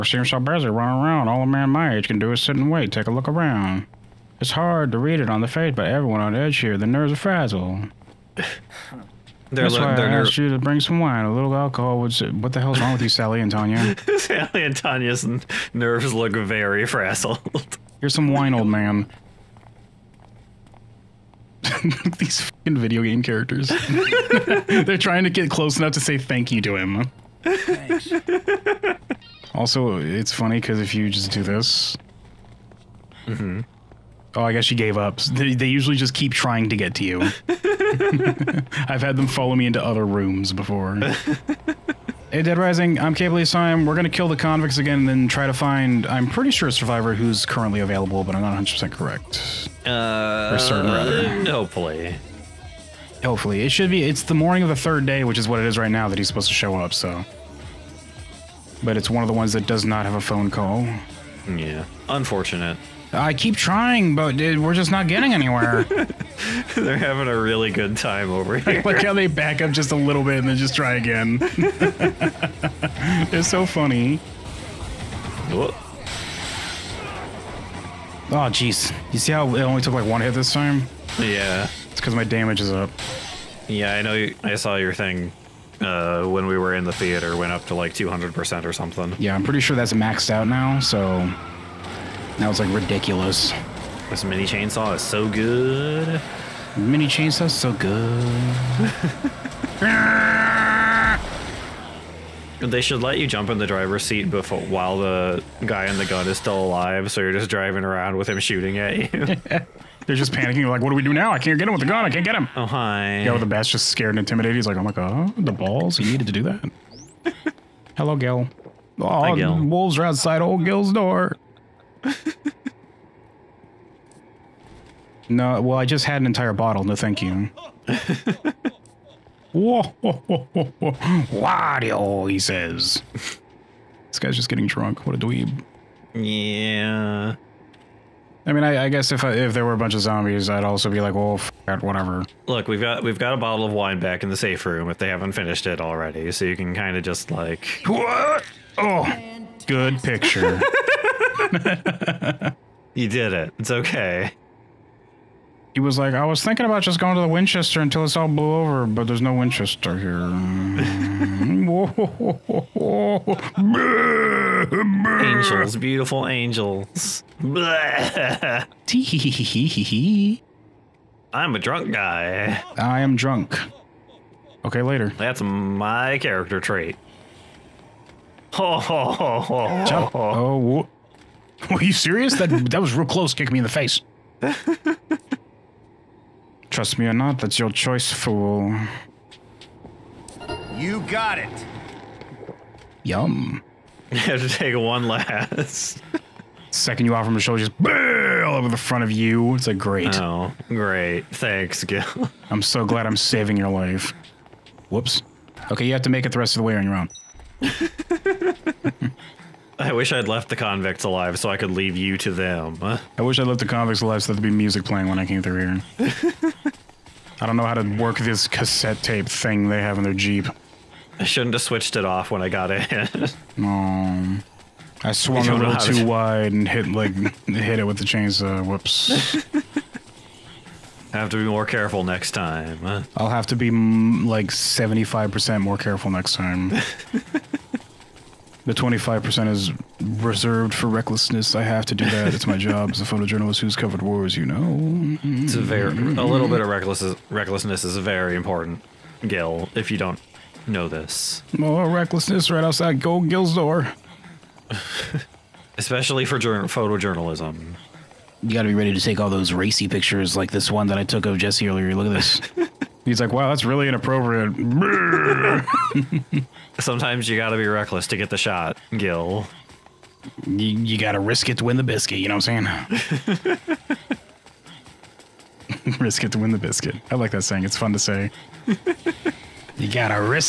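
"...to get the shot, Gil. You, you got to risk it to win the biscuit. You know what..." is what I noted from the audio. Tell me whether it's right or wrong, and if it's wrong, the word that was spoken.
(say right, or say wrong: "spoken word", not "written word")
right.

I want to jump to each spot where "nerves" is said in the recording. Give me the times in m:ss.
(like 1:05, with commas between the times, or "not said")
0:06, 0:15.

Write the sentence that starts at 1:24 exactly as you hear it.
You, I saw your thing uh, when we were in the theater went up to like 200% or something.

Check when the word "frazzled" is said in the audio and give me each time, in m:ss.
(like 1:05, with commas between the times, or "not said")
0:07, 0:16.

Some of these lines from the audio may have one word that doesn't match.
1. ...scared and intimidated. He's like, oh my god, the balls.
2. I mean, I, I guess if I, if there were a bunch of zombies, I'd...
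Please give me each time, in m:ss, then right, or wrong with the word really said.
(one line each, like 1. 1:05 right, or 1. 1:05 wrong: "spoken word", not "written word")
1. 1:53 right
2. 2:18 right.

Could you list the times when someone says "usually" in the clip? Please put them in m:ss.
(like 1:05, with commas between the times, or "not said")
0:35.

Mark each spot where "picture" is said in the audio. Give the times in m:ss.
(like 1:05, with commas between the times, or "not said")
2:30, 4:19.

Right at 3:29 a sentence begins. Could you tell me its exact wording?
I wish I'd left the convicts alive so I could leave you to them.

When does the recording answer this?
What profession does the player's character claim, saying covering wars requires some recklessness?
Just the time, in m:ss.
4:03.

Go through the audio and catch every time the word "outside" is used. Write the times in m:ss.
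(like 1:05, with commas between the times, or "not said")
2:00, 4:12.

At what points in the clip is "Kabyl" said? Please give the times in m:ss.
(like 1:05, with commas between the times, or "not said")
0:43.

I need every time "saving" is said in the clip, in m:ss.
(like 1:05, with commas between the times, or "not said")
3:23.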